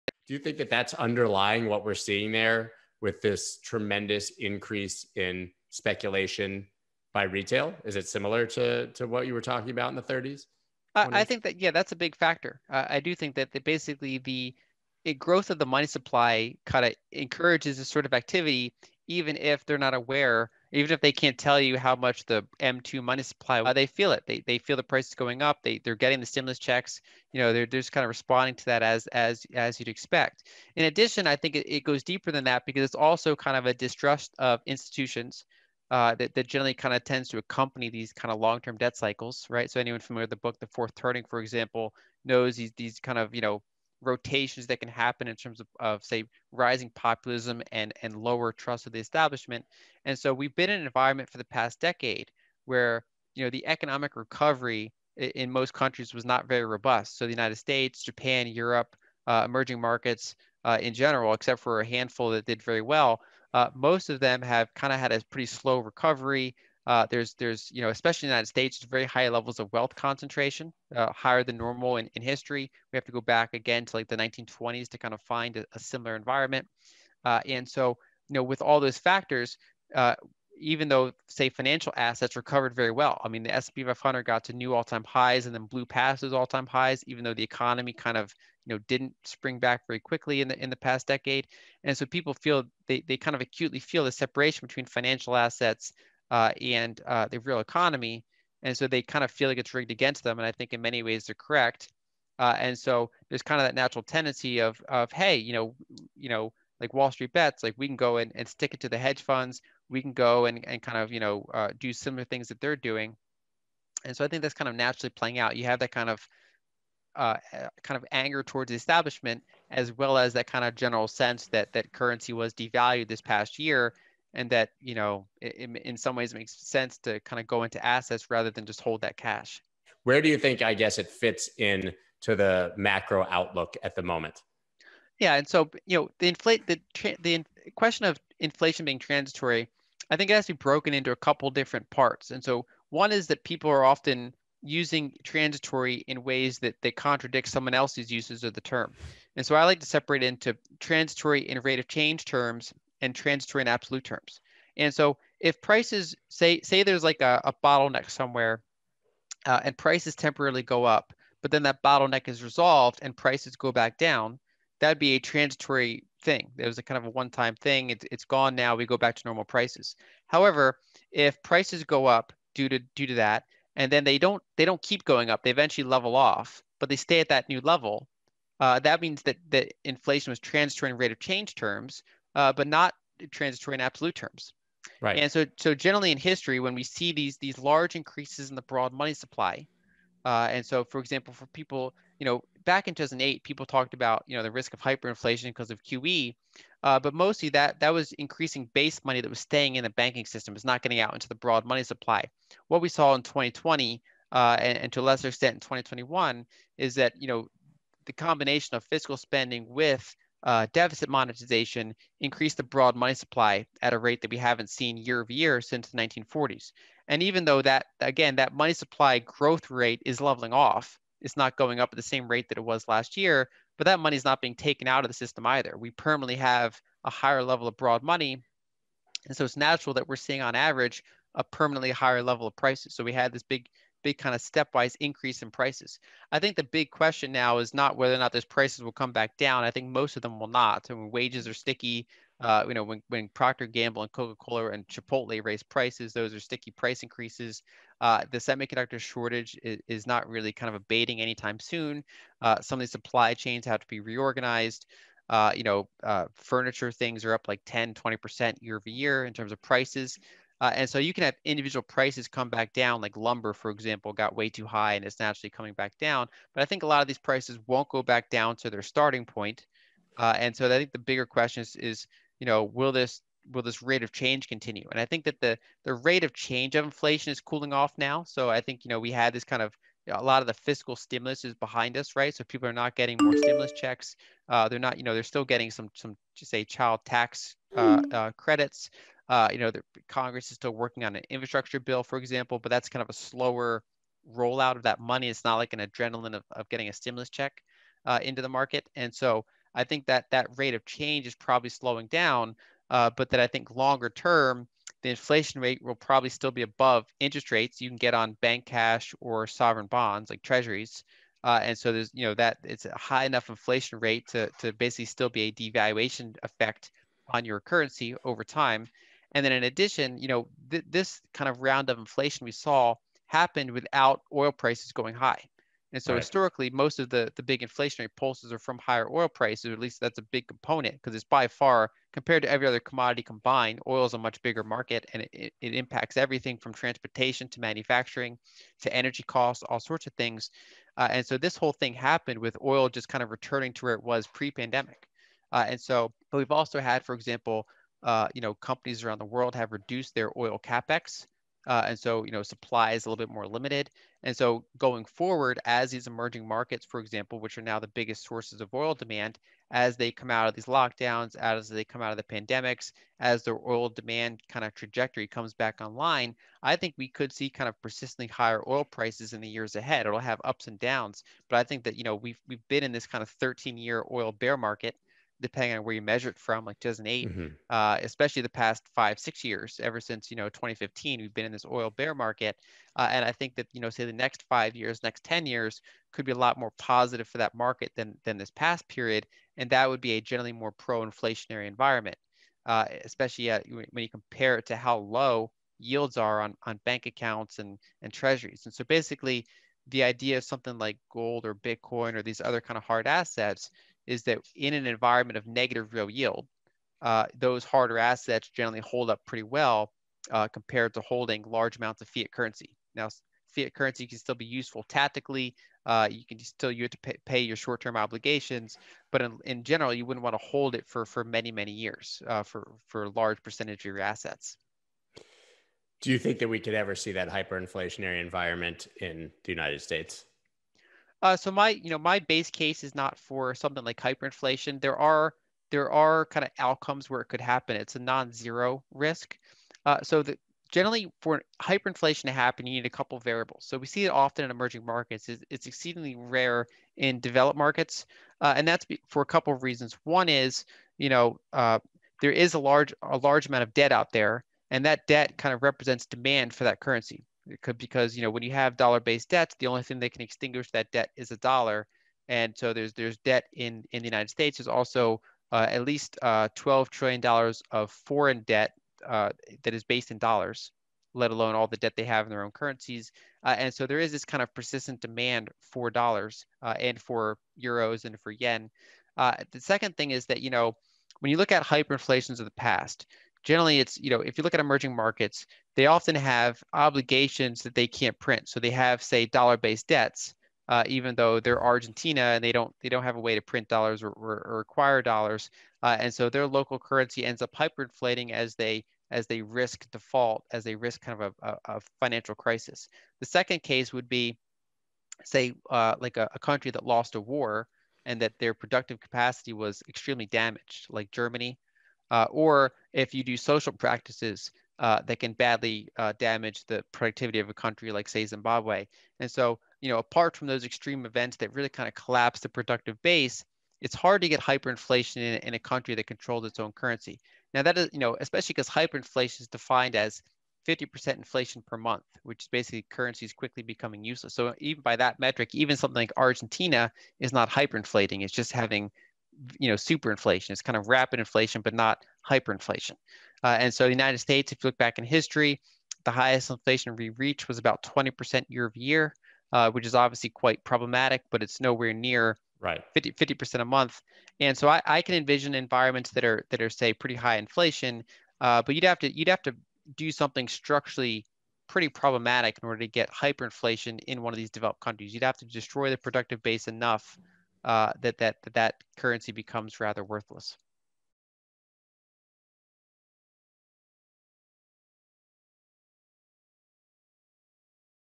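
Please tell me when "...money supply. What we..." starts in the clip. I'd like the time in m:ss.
3:21.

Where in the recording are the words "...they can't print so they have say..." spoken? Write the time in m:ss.
8:07.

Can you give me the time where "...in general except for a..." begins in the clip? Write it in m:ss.
1:00.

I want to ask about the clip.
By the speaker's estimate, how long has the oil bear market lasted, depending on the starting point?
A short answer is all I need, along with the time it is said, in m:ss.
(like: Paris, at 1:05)
13 years, at 6:13.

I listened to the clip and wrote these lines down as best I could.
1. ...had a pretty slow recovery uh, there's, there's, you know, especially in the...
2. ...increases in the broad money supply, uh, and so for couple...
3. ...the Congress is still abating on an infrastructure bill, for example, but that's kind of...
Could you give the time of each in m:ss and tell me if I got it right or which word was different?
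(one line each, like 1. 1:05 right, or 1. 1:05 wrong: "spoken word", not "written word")
1. 1:04 right
2. 3:07 wrong: "example", not "couple"
3. 4:49 wrong: "working", not "abating".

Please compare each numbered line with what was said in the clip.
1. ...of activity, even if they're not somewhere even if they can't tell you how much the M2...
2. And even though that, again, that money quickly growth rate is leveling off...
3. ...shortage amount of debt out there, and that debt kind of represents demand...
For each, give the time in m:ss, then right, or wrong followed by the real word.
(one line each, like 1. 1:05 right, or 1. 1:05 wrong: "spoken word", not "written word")
1. 0:18 wrong: "aware", not "somewhere"
2. 3:37 wrong: "supply", not "quickly"
3. 7:33 wrong: "large", not "shortage".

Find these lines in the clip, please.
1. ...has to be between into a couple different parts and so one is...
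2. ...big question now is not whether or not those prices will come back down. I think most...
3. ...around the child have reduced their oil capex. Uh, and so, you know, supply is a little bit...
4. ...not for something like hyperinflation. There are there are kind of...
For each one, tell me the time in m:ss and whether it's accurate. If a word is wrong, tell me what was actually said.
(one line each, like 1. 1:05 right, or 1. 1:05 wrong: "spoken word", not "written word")
1. 2:20 wrong: "broken", not "between"
2. 3:56 right
3. 5:49 wrong: "world", not "child"
4. 7:12 right.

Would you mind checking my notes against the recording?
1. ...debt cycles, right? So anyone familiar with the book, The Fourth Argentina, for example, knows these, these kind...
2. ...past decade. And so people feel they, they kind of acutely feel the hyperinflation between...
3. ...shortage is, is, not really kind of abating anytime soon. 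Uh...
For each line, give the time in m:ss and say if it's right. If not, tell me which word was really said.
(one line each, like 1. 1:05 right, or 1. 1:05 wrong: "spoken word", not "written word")
1. 0:38 wrong: "Turning", not "Argentina"
2. 1:30 wrong: "separation", not "hyperinflation"
3. 4:08 right.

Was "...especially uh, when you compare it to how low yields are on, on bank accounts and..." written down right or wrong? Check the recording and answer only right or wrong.
right.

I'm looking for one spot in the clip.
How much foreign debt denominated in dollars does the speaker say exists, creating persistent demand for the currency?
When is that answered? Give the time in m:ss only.
7:46.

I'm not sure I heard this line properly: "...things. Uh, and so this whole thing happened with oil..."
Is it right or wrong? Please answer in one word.
right.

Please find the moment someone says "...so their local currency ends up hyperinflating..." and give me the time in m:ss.
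8:16.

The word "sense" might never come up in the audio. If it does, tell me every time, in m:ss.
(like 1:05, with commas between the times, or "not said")
2:01, 2:06.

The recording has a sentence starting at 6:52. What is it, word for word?
Now, fiat currency can still be useful tactically.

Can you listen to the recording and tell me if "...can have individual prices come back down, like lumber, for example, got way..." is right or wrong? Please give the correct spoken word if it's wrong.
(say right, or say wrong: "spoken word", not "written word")
right.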